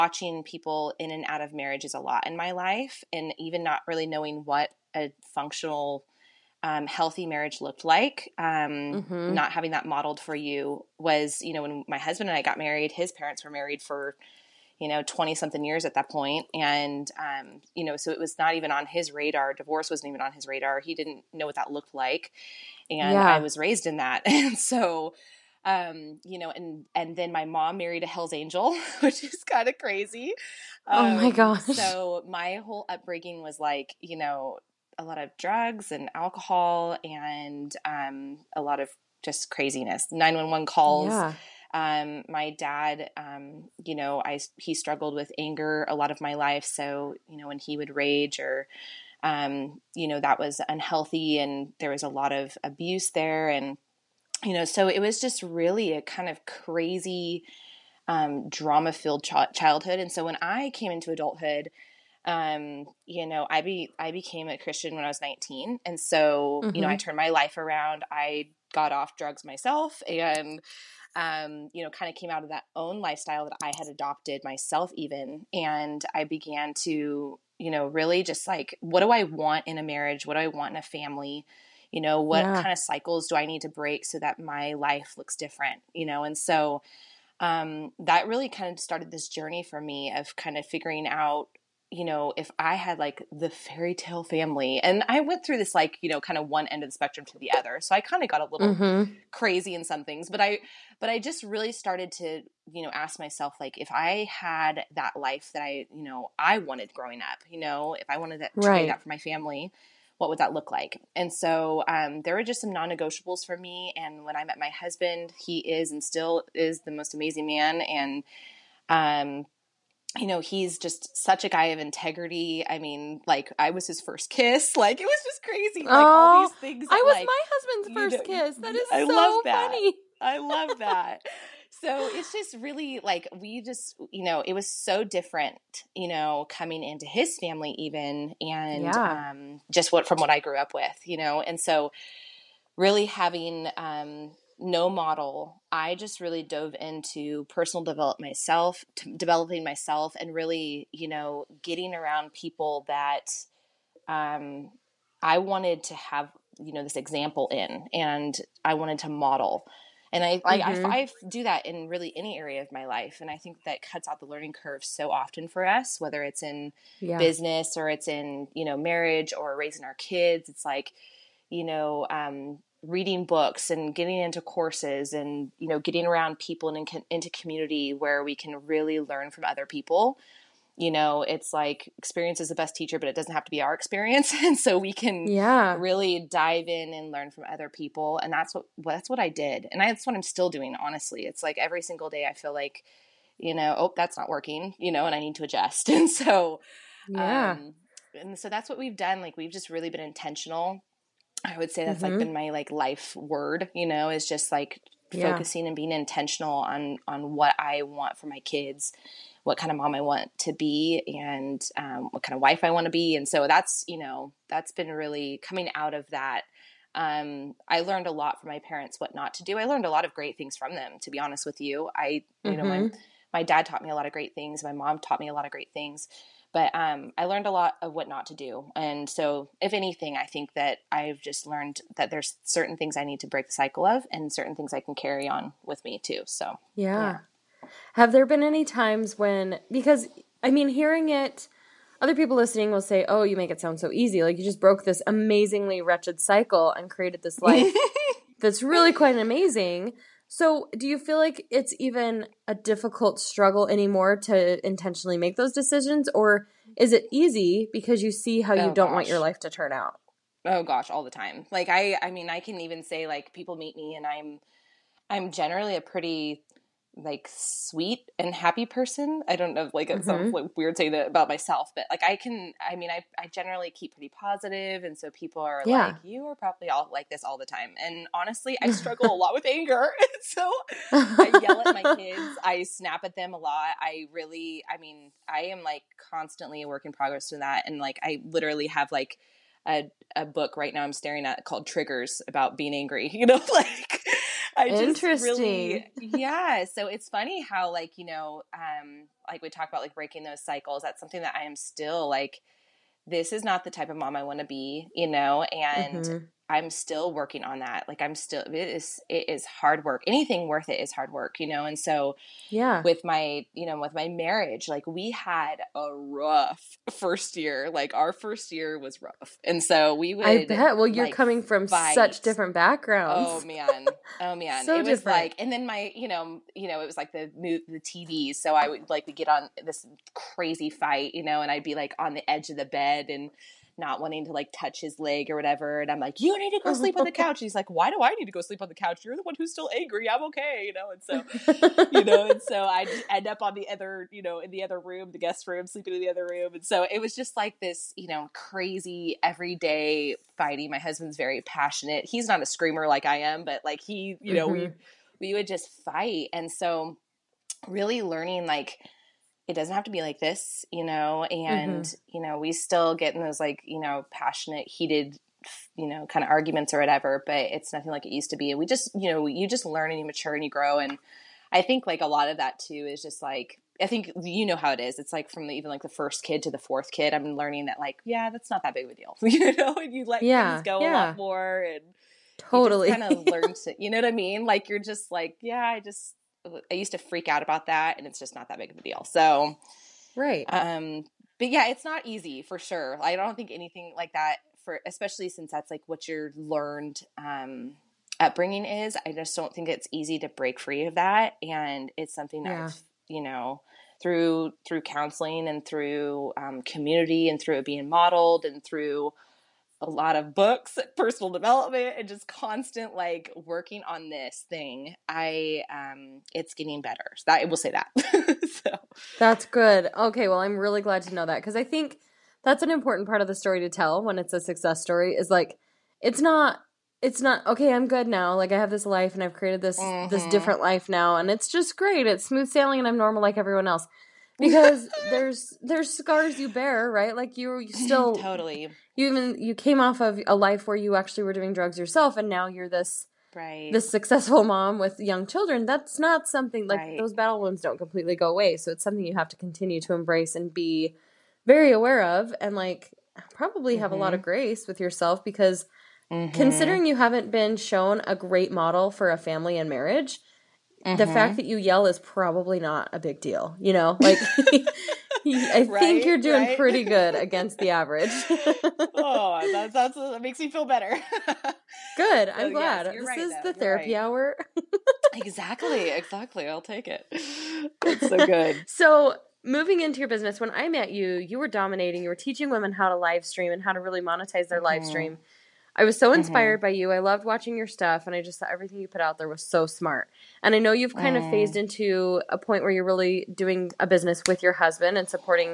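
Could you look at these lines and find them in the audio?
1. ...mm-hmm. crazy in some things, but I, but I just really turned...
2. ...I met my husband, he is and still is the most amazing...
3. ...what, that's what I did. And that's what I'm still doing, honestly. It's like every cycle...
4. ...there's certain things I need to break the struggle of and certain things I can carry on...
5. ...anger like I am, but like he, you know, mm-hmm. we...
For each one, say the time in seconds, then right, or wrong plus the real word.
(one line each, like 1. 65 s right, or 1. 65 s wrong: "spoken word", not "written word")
1. 98 s wrong: "started", not "turned"
2. 114 s right
3. 188 s wrong: "single", not "cycle"
4. 232 s wrong: "cycle", not "struggle"
5. 352 s wrong: "screamer", not "anger".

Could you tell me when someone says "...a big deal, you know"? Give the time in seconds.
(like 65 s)
462 s.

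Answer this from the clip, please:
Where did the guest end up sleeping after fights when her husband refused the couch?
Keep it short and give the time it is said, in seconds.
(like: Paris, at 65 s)
guest room, at 345 s.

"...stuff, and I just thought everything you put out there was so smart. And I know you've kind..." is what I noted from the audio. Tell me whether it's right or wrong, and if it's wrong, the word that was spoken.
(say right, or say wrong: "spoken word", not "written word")
right.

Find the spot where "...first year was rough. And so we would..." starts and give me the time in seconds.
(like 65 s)
318 s.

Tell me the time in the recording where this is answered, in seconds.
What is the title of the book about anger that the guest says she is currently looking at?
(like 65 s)
291 s.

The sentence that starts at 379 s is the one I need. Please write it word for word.
And you let yeah, things go yeah.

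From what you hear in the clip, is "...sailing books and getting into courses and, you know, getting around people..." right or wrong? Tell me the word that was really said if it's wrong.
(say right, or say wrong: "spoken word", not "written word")
wrong: "reading", not "sailing".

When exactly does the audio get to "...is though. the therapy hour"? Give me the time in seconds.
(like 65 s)
473 s.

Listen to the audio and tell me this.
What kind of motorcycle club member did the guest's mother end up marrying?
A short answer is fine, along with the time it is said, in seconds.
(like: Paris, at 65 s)
Hell's Angel, at 28 s.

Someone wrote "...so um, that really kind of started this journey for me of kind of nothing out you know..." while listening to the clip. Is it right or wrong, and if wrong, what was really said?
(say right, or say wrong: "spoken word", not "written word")
wrong: "figuring", not "nothing".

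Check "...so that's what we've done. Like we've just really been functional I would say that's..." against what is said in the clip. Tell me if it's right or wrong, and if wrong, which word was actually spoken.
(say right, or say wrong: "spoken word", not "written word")
wrong: "intentional", not "functional".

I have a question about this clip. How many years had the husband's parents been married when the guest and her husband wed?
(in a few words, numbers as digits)
20 something.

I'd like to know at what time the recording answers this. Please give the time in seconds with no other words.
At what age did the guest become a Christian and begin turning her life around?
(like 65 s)
65 s.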